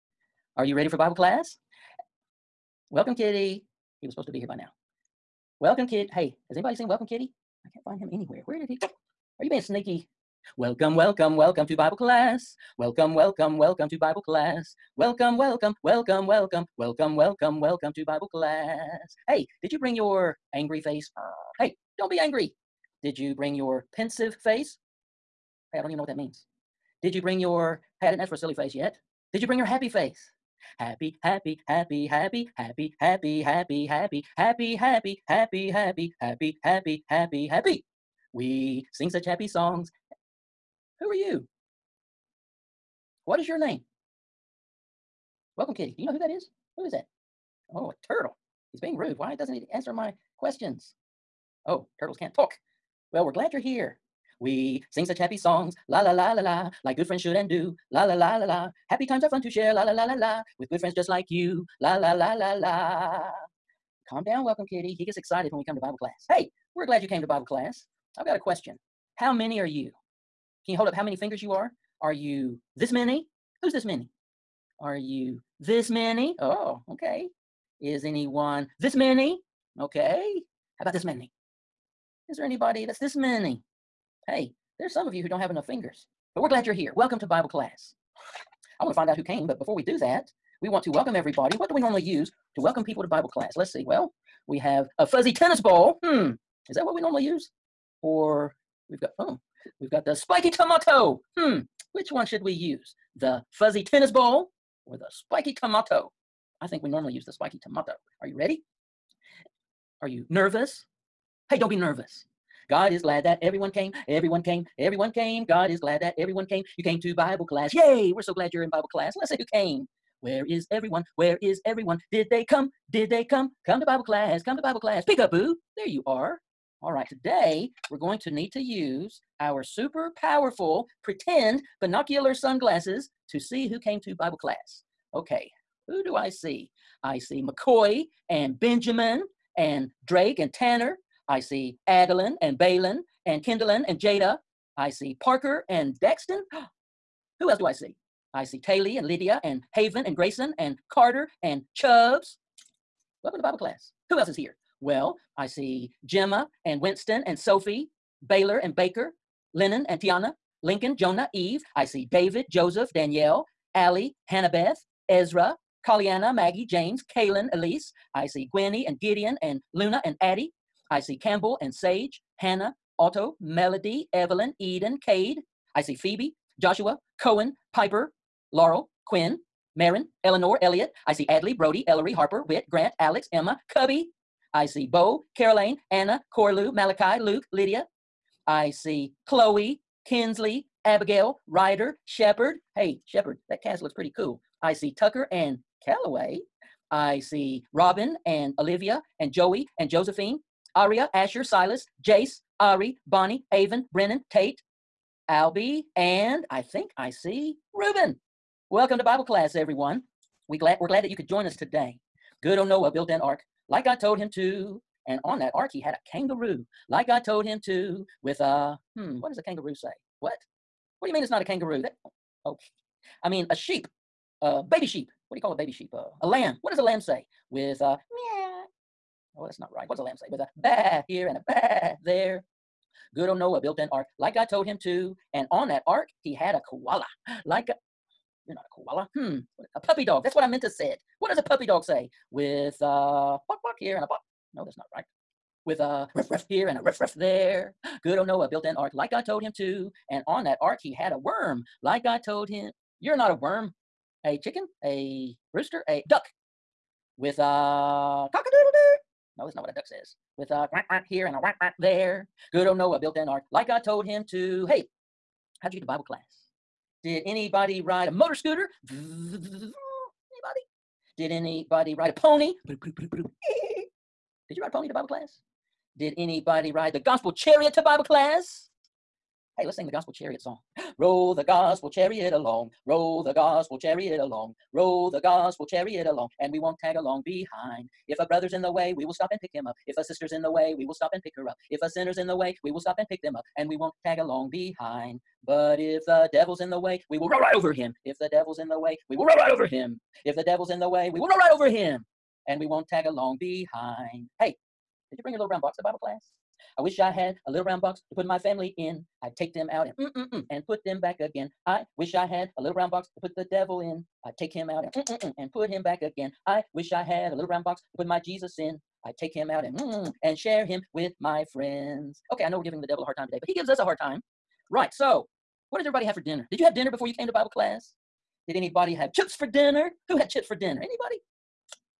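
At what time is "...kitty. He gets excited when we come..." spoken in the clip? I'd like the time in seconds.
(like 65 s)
64 s.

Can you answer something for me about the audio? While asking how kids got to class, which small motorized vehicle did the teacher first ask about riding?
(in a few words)
motor scooter.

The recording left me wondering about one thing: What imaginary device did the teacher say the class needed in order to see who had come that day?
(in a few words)
pretend binocular sunglasses.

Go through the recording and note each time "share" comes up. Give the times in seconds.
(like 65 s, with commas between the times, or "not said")
59 s, 320 s.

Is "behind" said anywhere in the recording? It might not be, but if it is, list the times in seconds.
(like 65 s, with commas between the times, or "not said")
287 s, 294 s, 303 s.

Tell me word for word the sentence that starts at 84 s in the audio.
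Hey, there's some of you who don't have enough fingers, but we're glad you're here.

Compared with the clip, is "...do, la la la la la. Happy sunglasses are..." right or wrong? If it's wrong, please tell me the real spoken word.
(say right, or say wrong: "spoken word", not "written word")
wrong: "times", not "sunglasses".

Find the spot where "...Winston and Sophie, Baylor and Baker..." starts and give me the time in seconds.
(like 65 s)
156 s.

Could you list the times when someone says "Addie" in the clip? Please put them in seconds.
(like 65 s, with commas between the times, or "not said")
170 s.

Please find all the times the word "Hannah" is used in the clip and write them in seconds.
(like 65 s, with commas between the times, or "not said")
164 s, 172 s.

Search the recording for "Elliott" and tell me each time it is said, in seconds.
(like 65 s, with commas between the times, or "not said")
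180 s.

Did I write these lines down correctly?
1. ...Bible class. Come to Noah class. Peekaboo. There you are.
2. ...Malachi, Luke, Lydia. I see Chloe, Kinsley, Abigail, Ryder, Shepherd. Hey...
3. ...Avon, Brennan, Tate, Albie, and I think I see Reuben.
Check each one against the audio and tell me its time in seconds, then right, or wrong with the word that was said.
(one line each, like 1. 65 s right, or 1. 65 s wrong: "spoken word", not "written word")
1. 123 s wrong: "Bible", not "Noah"
2. 186 s right
3. 203 s right.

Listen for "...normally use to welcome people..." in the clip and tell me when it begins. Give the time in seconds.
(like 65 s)
91 s.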